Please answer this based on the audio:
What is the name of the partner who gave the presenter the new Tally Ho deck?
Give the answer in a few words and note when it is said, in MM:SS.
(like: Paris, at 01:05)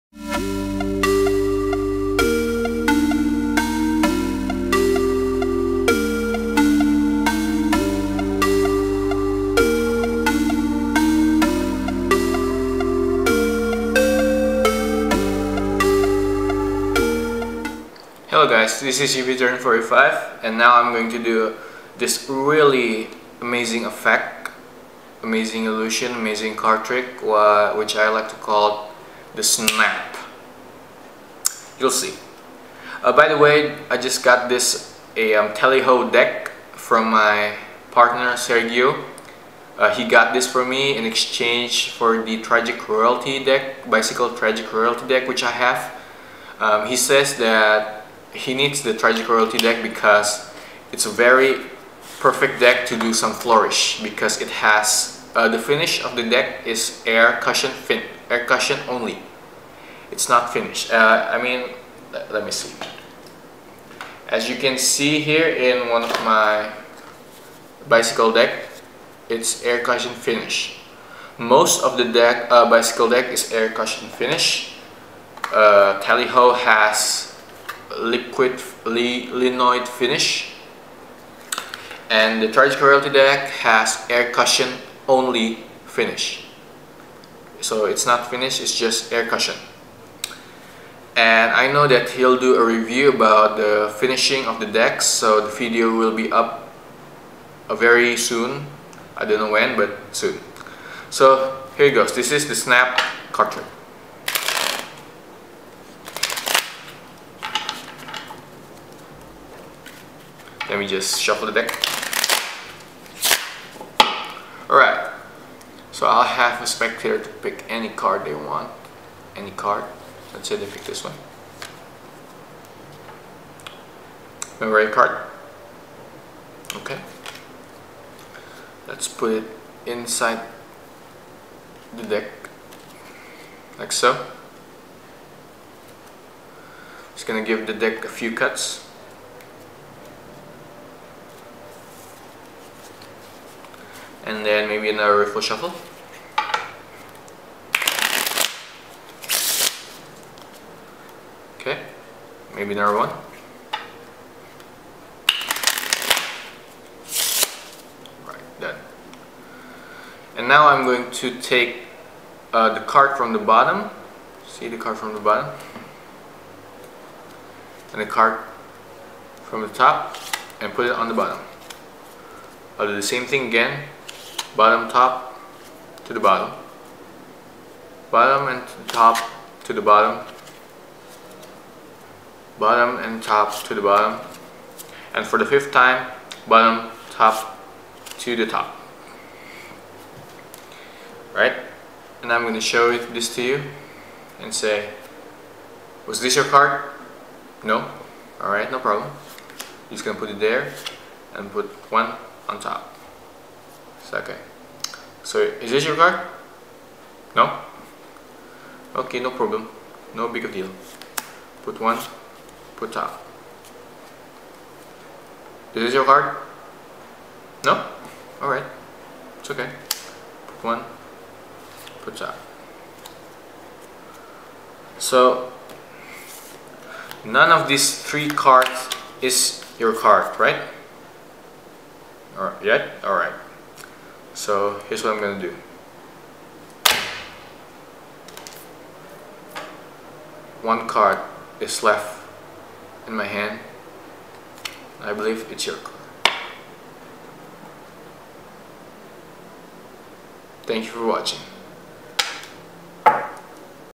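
Sergio, at 00:38.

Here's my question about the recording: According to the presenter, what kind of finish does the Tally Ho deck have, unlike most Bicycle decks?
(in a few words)
linoid finish.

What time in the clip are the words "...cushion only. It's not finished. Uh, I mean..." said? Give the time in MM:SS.
00:58.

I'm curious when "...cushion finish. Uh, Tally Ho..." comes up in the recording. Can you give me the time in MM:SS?
01:13.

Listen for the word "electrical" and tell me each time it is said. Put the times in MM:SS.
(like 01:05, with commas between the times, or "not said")
not said.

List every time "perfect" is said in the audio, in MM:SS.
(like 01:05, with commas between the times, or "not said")
00:52.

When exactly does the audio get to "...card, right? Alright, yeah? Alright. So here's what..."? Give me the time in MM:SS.
03:49.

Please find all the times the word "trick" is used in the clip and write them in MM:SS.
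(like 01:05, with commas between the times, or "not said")
00:26, 01:43.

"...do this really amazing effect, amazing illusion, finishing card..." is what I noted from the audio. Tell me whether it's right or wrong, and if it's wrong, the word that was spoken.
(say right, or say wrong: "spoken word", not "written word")
wrong: "amazing", not "finishing".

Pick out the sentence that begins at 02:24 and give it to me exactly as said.
and then maybe another riffle shuffle.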